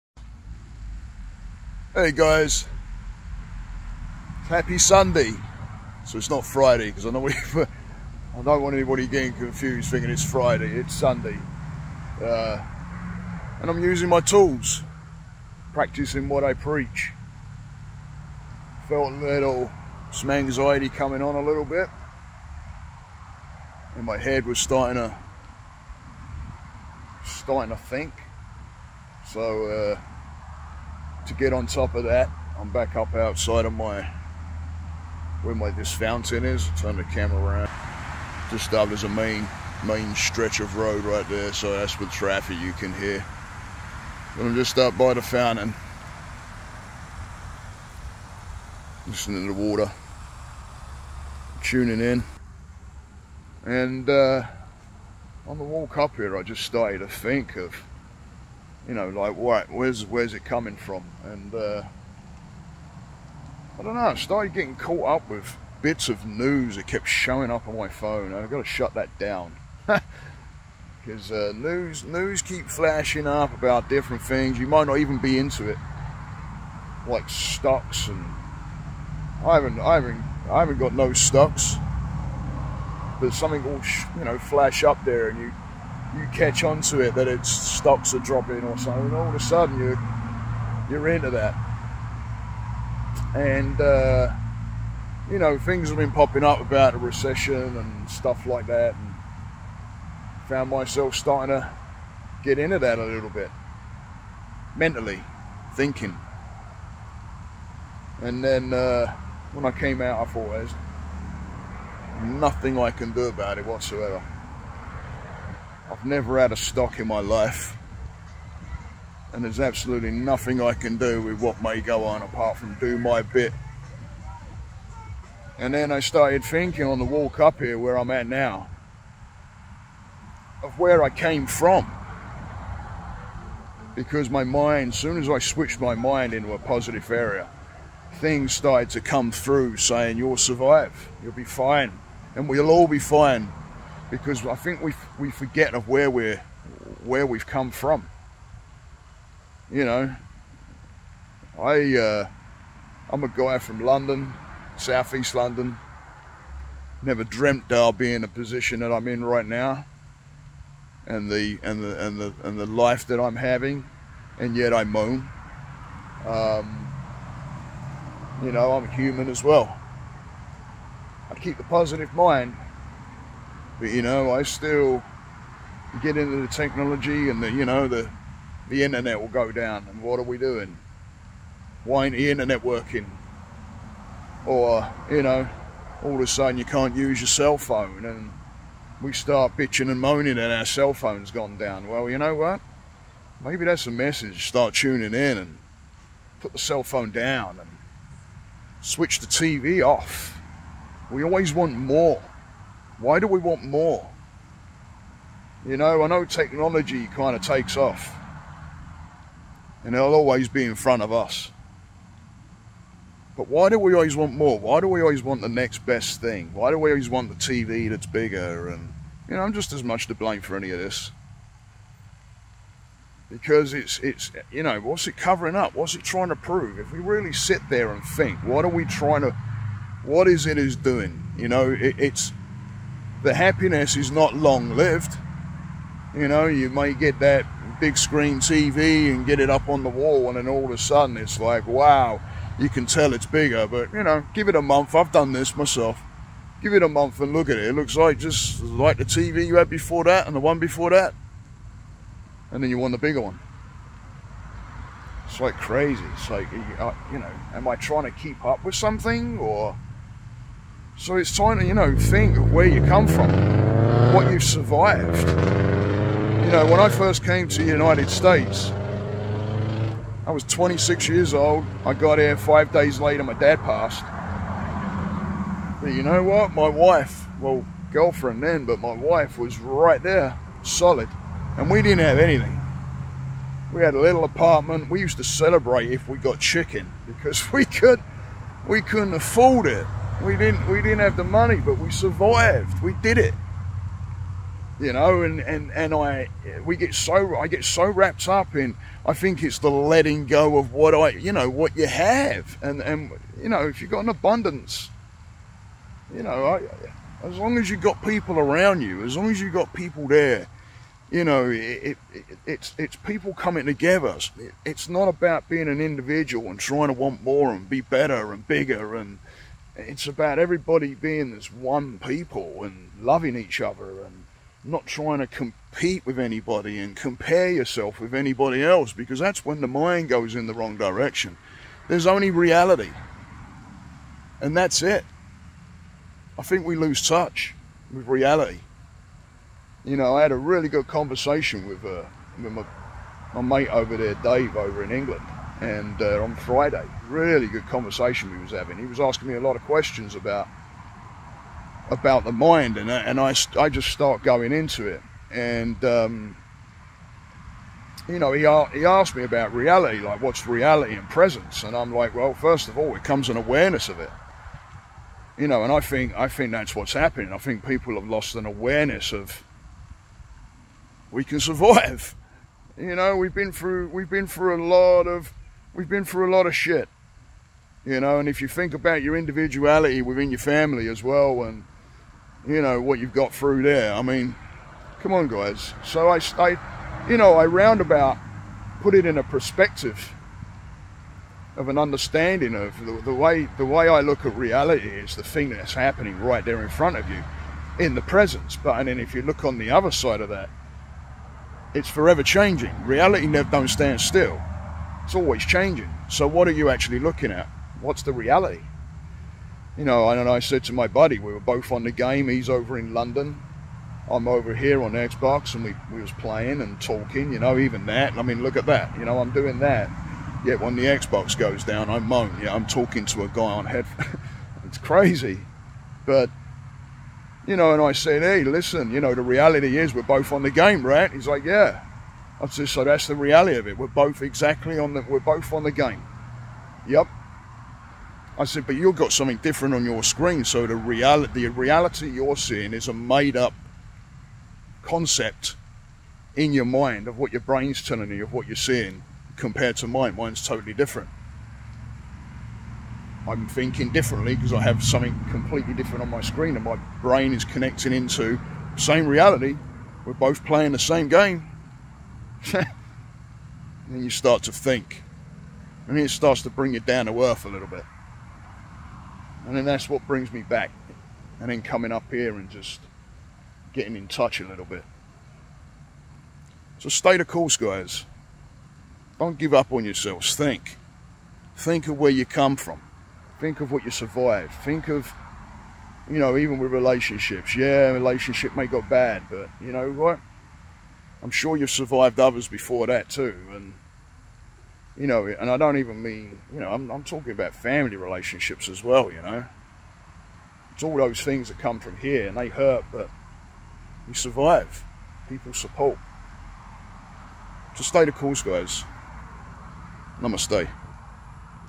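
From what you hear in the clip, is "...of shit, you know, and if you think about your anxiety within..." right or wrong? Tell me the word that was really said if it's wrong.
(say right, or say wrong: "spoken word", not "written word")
wrong: "individuality", not "anxiety".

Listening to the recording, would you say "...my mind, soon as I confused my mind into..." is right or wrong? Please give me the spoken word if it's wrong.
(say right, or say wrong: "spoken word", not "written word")
wrong: "switched", not "confused".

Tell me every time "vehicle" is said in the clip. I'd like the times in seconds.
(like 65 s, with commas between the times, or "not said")
not said.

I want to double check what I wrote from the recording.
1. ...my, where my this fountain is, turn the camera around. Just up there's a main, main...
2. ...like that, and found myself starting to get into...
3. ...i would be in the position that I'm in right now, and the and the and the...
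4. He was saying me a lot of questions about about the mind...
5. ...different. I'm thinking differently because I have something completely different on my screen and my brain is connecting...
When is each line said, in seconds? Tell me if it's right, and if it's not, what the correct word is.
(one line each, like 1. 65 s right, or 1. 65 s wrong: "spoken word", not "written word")
1. 33 s right
2. 98 s right
3. 157 s right
4. 348 s wrong: "asking", not "saying"
5. 450 s right.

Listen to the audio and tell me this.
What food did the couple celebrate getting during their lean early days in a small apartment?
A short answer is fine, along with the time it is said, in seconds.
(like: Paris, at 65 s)
Chicken, at 286 s.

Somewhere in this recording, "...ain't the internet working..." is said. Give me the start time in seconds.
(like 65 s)
182 s.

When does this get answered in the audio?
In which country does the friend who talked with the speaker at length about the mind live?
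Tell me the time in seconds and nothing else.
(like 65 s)
344 s.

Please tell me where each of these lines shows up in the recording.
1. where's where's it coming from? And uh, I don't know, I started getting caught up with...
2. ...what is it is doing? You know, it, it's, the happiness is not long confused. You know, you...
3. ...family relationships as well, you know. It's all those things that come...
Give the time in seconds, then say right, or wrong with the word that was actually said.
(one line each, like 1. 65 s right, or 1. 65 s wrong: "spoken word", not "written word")
1. 59 s right
2. 230 s wrong: "lived", not "confused"
3. 497 s right.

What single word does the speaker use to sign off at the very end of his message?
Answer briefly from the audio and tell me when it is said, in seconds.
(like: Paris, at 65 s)
Namaste, at 510 s.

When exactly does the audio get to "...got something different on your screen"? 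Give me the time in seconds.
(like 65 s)
438 s.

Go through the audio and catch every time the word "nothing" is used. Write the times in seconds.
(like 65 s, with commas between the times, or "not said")
112 s, 120 s.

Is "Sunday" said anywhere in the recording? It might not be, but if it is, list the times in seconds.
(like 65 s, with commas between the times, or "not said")
4 s, 10 s.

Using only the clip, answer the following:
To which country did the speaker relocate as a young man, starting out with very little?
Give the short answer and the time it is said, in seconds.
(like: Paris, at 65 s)
United States, at 267 s.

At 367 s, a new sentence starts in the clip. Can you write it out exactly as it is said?
I think people have lost an awareness of we can survive.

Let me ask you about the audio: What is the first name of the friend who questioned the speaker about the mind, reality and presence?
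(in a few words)
Dave.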